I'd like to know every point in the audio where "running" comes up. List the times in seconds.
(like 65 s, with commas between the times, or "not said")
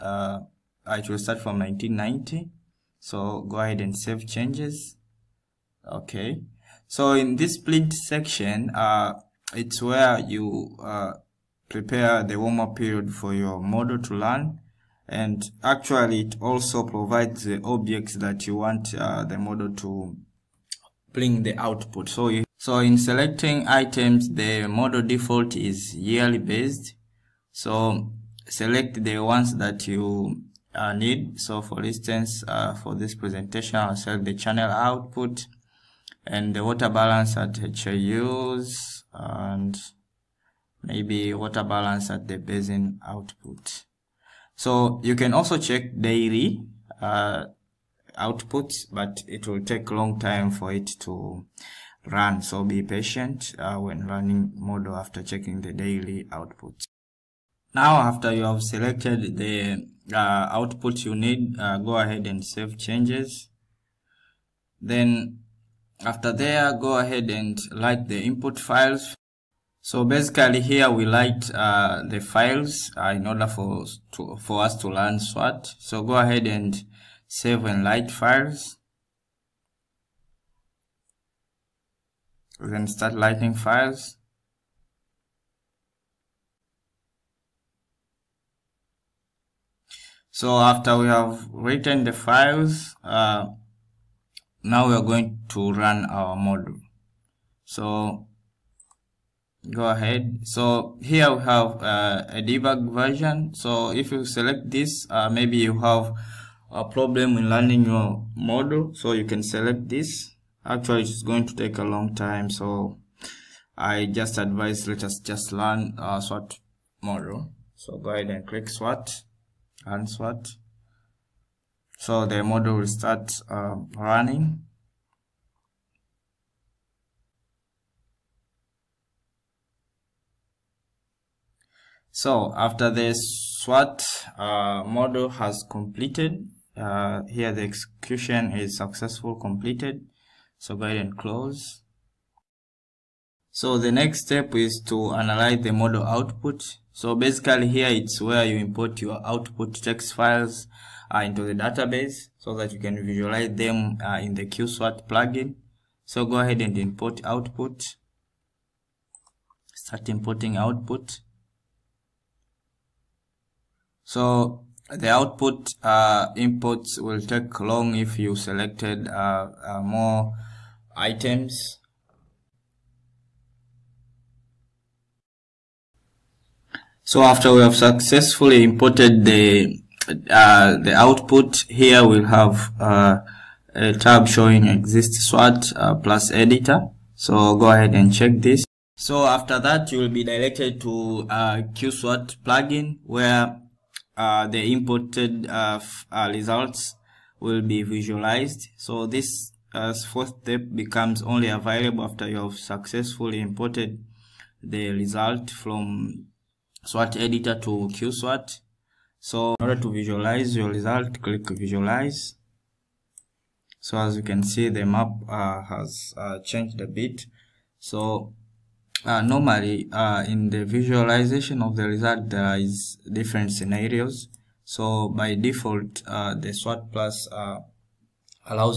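54 s, 123 s.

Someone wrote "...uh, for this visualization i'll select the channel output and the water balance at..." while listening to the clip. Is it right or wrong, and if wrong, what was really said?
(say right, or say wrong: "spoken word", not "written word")
wrong: "presentation", not "visualization".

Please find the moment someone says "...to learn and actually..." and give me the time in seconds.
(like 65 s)
13 s.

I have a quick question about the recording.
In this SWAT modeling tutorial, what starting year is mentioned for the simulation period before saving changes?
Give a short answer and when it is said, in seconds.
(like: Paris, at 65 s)
1990, at 1 s.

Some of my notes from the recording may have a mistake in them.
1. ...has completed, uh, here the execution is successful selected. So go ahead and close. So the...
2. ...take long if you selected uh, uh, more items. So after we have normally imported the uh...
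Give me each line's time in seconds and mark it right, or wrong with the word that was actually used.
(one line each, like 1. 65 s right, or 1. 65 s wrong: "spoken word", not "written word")
1. 135 s wrong: "completed", not "selected"
2. 167 s wrong: "successfully", not "normally".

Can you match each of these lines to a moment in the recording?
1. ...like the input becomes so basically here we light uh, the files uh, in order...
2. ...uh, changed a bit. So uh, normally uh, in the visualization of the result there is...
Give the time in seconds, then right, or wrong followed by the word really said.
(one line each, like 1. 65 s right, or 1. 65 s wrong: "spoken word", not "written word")
1. 67 s wrong: "files", not "becomes"
2. 216 s right.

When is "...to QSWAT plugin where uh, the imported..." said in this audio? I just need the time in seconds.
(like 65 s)
190 s.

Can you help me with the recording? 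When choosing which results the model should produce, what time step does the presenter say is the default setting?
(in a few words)
Yearly.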